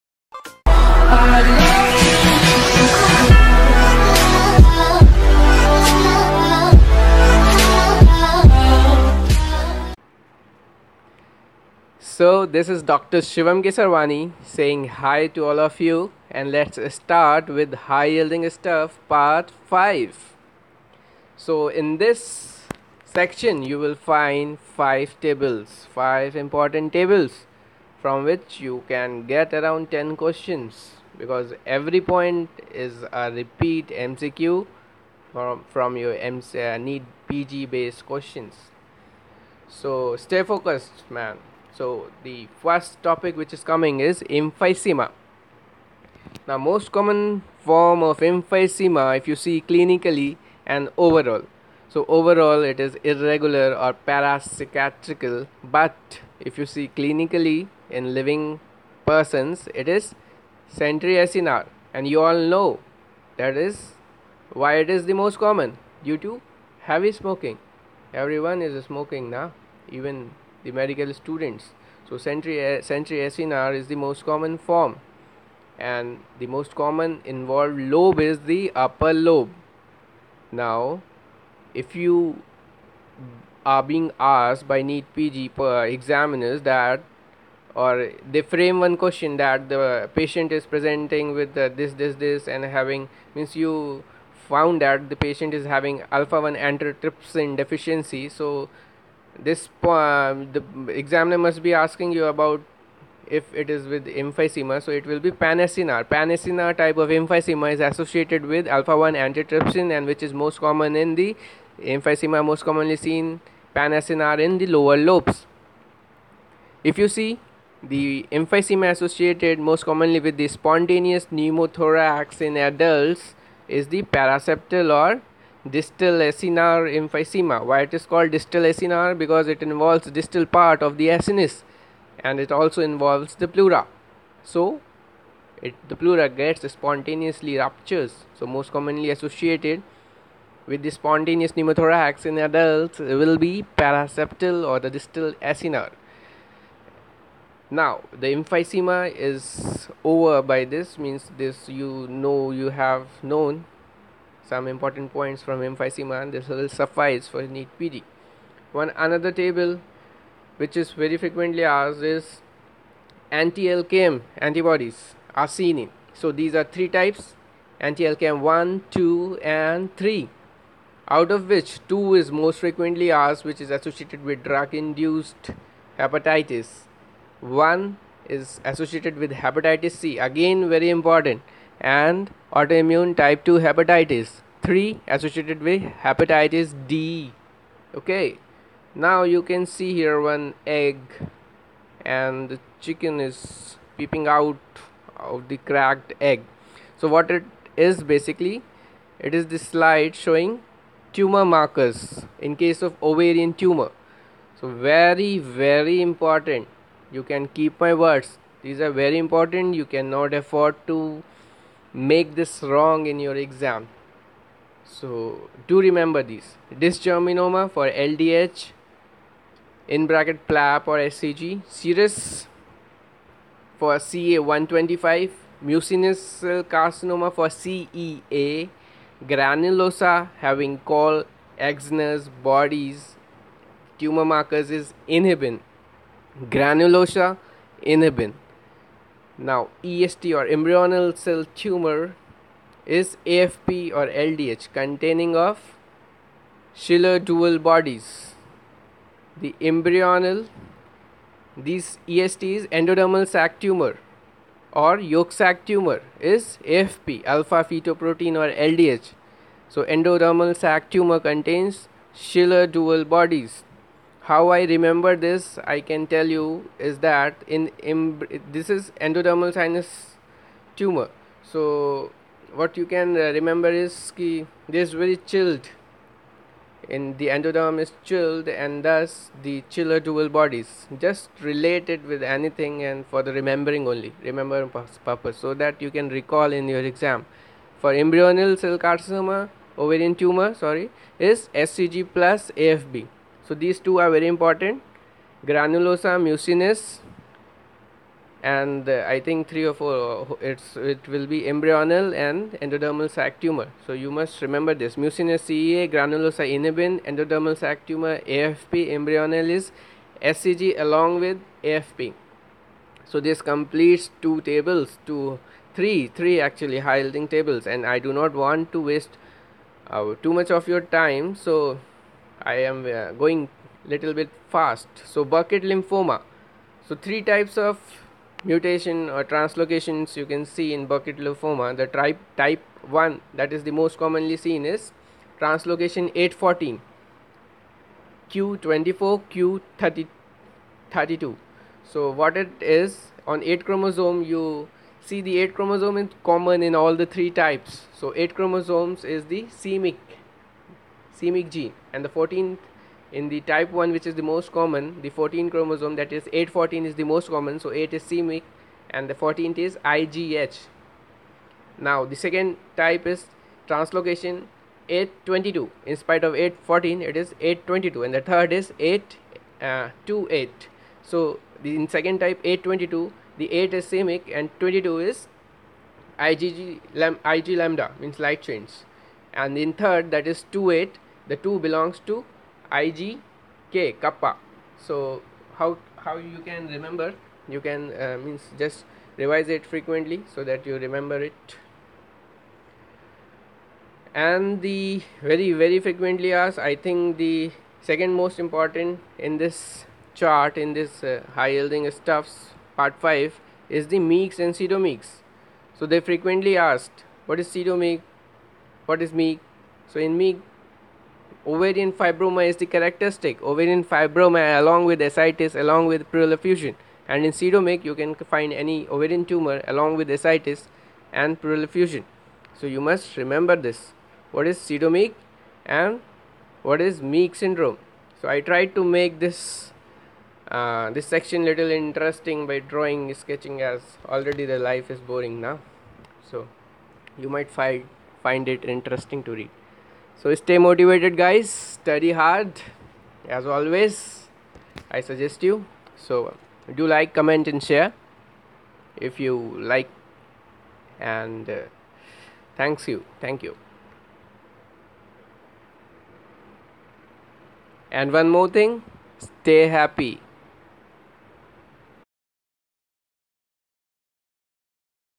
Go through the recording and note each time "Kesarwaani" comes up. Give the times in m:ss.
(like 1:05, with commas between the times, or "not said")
0:13.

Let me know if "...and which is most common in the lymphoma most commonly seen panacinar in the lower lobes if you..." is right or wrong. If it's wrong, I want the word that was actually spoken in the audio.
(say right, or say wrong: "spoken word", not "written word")
wrong: "emphysema", not "lymphoma".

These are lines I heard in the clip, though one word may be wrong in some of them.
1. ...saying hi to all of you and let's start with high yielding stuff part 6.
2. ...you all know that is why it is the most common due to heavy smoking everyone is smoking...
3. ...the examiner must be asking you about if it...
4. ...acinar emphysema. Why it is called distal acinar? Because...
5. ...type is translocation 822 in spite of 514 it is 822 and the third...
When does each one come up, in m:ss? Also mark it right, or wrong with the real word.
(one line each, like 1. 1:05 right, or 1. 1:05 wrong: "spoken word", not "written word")
1. 0:14 wrong: "5", not "6"
2. 1:02 right
3. 1:40 right
4. 2:06 right
5. 6:02 wrong: "814", not "514".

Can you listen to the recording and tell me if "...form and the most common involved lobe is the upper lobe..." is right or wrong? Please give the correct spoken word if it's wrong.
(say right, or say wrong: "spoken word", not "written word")
right.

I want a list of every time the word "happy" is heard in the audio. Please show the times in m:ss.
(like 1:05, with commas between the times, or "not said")
7:39.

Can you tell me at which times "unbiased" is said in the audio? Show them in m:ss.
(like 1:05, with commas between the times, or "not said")
not said.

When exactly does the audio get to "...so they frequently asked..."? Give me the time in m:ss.
6:45.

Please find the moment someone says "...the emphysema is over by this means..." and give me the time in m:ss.
2:28.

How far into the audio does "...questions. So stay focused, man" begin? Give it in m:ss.
0:38.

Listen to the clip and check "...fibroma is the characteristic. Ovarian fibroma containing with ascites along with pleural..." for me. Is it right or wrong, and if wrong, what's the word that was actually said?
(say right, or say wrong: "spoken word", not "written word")
wrong: "along", not "containing".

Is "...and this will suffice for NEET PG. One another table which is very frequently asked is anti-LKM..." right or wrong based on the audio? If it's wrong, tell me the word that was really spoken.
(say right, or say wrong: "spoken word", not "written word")
right.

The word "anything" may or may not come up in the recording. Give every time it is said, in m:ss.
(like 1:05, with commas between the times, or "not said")
4:42.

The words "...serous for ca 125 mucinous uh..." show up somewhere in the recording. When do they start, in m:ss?
3:41.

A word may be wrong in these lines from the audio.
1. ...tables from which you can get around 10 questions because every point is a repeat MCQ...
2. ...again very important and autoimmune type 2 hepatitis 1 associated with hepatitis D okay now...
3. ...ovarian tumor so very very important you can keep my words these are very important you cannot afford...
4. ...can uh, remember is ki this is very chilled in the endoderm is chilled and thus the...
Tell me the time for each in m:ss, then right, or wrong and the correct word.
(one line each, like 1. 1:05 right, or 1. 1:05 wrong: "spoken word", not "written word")
1. 0:26 right
2. 3:00 wrong: "3", not "1"
3. 3:23 right
4. 4:32 right.